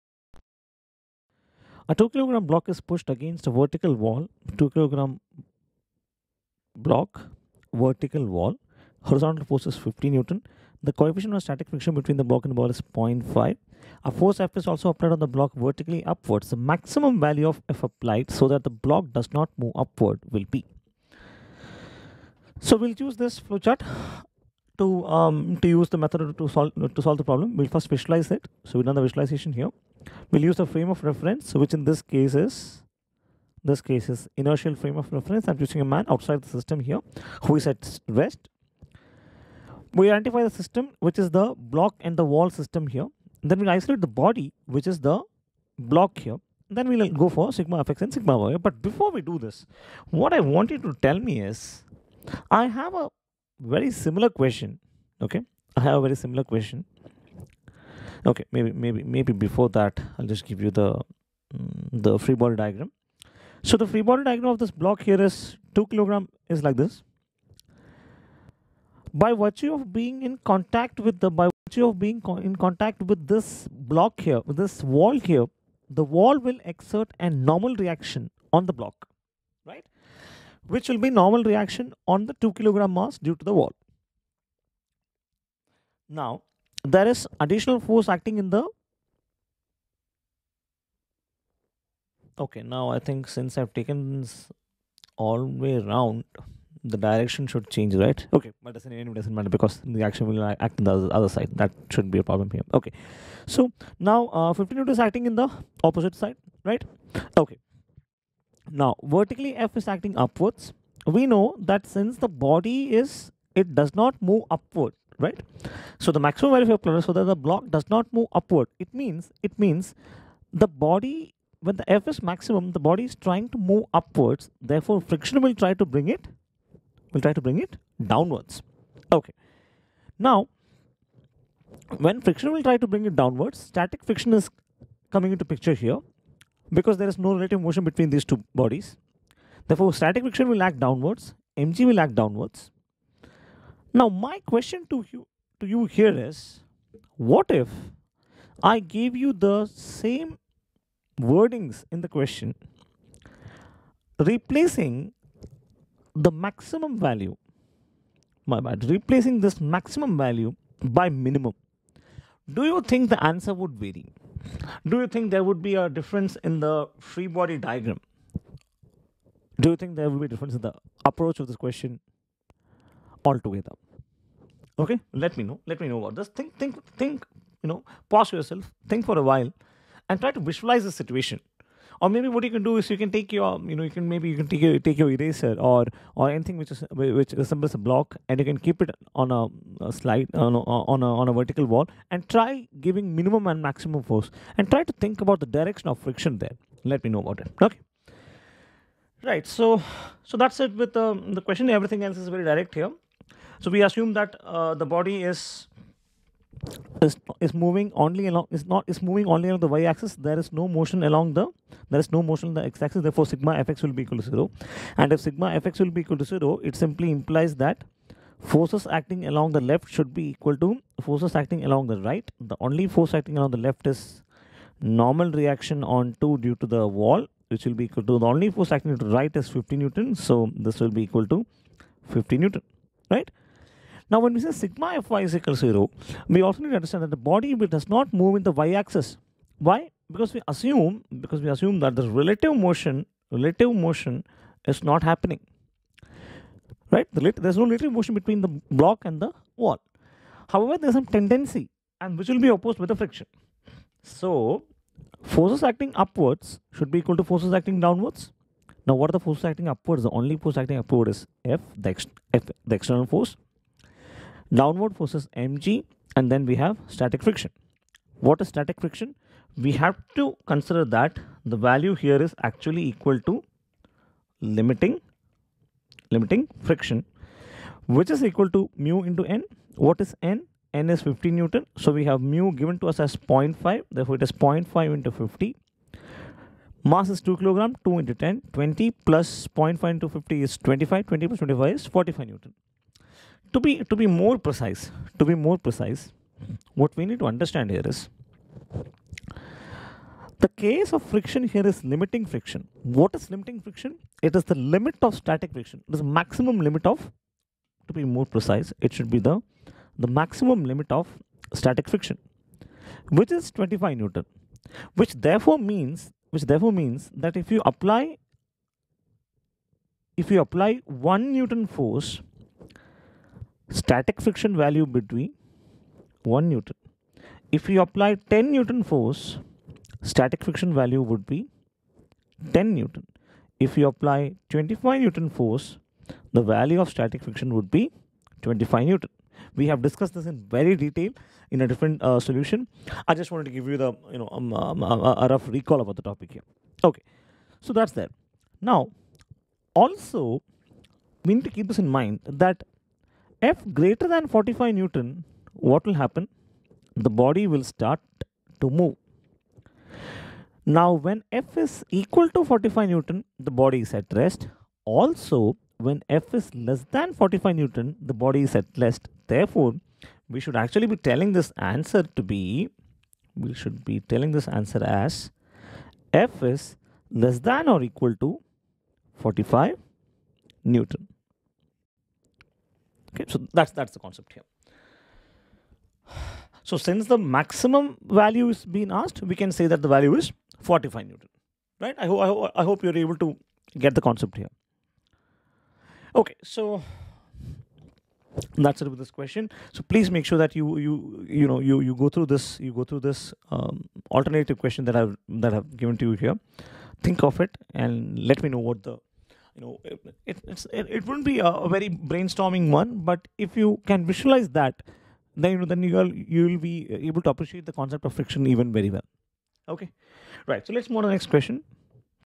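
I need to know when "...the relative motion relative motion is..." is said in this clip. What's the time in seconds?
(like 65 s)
241 s.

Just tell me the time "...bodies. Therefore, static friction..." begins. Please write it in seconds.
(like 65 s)
138 s.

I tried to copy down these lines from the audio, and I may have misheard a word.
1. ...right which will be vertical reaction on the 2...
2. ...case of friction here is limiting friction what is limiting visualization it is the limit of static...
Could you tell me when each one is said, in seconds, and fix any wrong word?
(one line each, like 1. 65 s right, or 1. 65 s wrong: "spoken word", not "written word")
1. 79 s wrong: "normal", not "vertical"
2. 300 s wrong: "friction", not "visualization".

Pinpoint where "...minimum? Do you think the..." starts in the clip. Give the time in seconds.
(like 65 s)
161 s.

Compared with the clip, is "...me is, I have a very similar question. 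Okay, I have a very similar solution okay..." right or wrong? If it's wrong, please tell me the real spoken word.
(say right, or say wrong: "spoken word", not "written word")
wrong: "question", not "solution".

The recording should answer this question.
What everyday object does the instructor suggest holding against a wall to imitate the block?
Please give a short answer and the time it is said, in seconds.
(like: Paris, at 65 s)
eraser, at 185 s.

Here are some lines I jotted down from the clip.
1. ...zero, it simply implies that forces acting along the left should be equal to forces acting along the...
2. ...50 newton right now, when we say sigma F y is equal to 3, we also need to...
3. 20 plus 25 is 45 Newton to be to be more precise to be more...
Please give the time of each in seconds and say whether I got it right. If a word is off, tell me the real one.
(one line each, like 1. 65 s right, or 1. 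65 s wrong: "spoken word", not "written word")
1. 216 s right
2. 232 s wrong: "0", not "3"
3. 291 s right.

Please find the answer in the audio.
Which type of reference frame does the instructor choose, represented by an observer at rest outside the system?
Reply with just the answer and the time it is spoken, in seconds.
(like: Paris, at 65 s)
inertial frame of reference, at 34 s.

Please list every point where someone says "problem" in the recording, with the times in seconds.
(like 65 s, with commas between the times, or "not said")
27 s, 102 s.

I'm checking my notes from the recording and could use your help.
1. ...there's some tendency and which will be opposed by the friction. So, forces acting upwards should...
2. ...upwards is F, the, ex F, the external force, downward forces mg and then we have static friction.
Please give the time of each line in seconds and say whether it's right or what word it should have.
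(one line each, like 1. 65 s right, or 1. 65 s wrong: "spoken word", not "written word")
1. 250 s right
2. 260 s right.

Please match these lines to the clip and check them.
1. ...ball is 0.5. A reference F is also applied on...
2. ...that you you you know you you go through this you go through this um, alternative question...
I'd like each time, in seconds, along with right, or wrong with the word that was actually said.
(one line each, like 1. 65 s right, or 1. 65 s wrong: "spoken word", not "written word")
1. 12 s wrong: "force", not "reference"
2. 400 s right.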